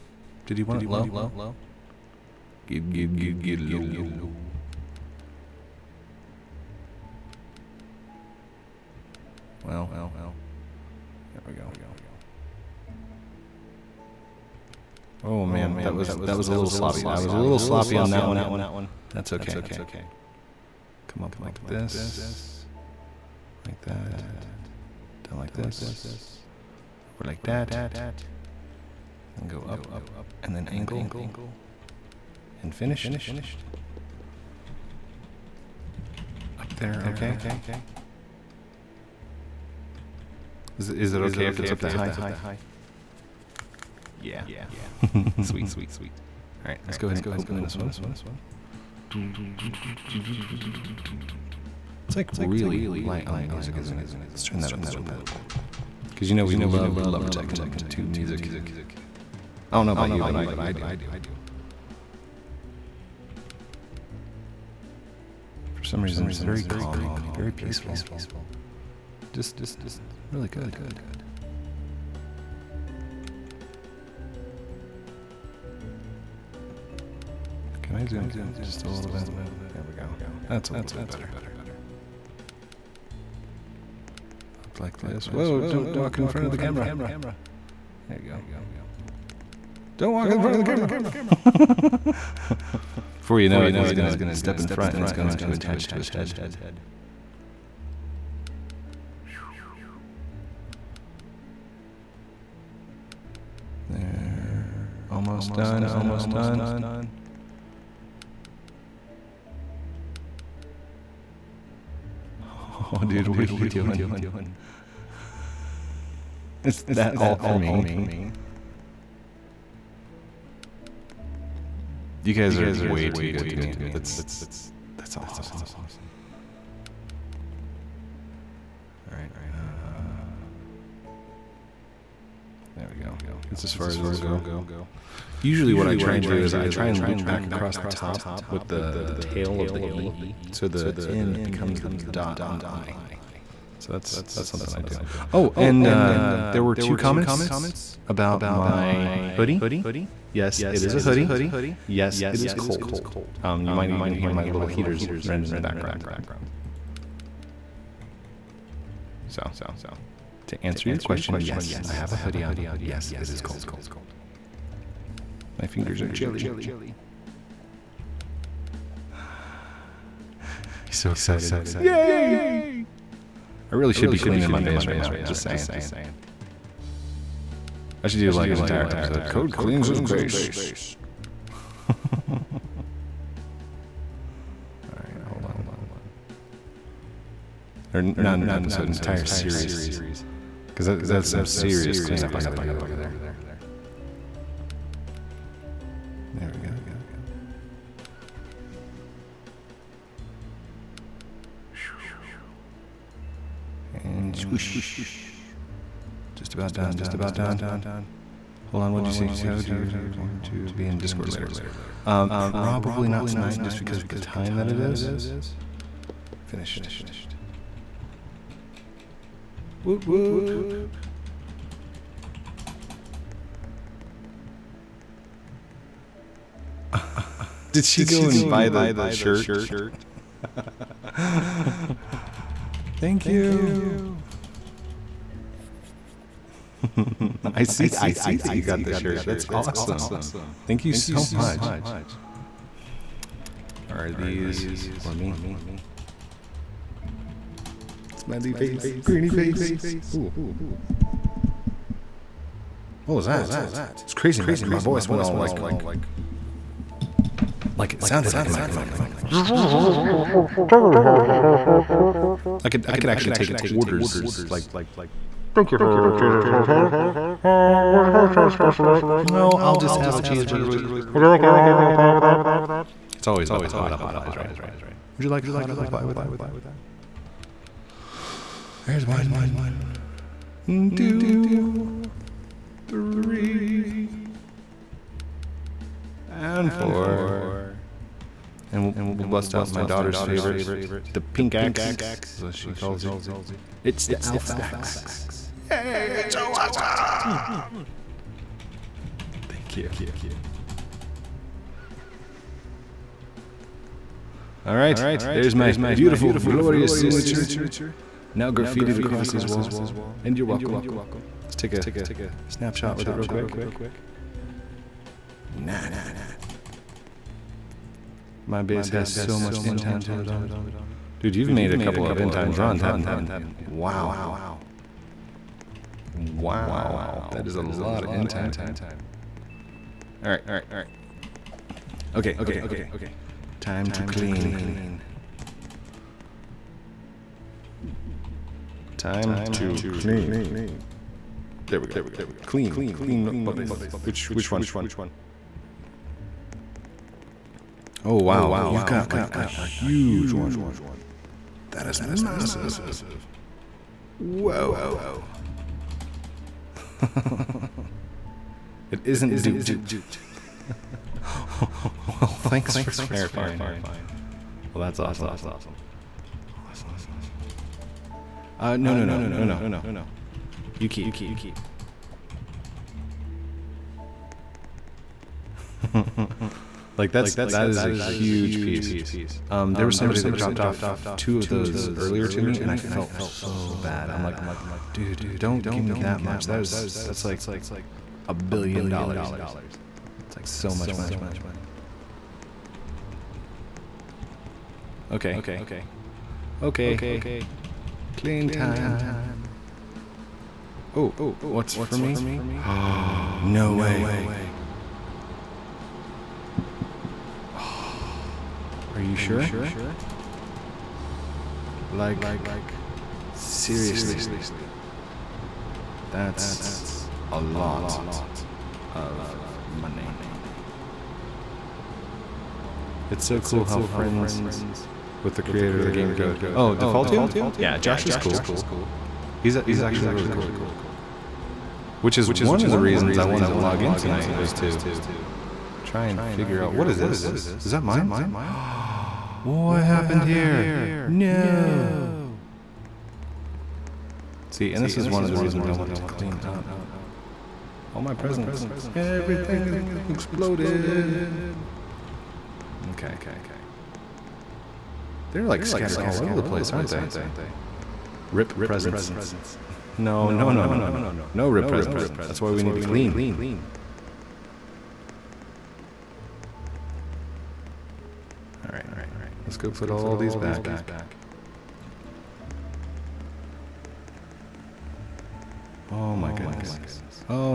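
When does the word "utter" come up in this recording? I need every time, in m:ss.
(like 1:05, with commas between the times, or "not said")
not said.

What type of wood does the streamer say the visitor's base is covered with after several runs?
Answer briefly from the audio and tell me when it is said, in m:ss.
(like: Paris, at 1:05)
end times wood, at 5:19.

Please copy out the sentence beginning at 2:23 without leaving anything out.
So that's that's something I do.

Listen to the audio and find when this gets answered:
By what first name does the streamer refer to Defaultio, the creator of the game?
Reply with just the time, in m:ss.
7:07.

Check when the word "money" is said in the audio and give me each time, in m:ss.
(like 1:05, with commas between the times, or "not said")
6:30, 6:59.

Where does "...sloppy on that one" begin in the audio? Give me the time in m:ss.
0:17.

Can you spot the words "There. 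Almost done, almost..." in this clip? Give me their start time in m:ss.
1:43.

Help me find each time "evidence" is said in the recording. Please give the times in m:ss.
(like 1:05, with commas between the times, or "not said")
not said.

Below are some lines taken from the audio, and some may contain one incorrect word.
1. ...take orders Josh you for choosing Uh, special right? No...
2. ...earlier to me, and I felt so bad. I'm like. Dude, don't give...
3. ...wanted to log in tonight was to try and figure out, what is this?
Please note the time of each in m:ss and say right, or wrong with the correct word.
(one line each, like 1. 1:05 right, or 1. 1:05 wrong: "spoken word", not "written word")
1. 4:23 wrong: "Thank", not "Josh"
2. 6:21 right
3. 7:13 right.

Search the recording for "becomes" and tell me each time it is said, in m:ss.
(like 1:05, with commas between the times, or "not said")
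2:21.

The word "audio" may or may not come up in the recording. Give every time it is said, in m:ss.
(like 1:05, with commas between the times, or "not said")
not said.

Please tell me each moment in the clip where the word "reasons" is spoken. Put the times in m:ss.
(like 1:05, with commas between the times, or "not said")
1:06, 7:12, 7:25.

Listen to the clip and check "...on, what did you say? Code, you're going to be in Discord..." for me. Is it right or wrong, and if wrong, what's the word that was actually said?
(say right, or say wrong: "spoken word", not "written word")
right.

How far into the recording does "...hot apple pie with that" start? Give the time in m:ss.
4:35.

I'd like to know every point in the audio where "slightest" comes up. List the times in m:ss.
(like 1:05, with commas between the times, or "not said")
not said.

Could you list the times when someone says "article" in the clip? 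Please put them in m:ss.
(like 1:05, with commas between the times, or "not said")
not said.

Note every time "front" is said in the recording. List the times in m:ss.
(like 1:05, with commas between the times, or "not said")
1:26, 1:30, 1:34.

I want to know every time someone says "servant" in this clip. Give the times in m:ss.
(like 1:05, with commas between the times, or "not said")
not said.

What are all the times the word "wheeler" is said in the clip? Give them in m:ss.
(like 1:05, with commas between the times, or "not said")
not said.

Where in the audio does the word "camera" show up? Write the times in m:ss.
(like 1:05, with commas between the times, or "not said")
1:26, 1:30.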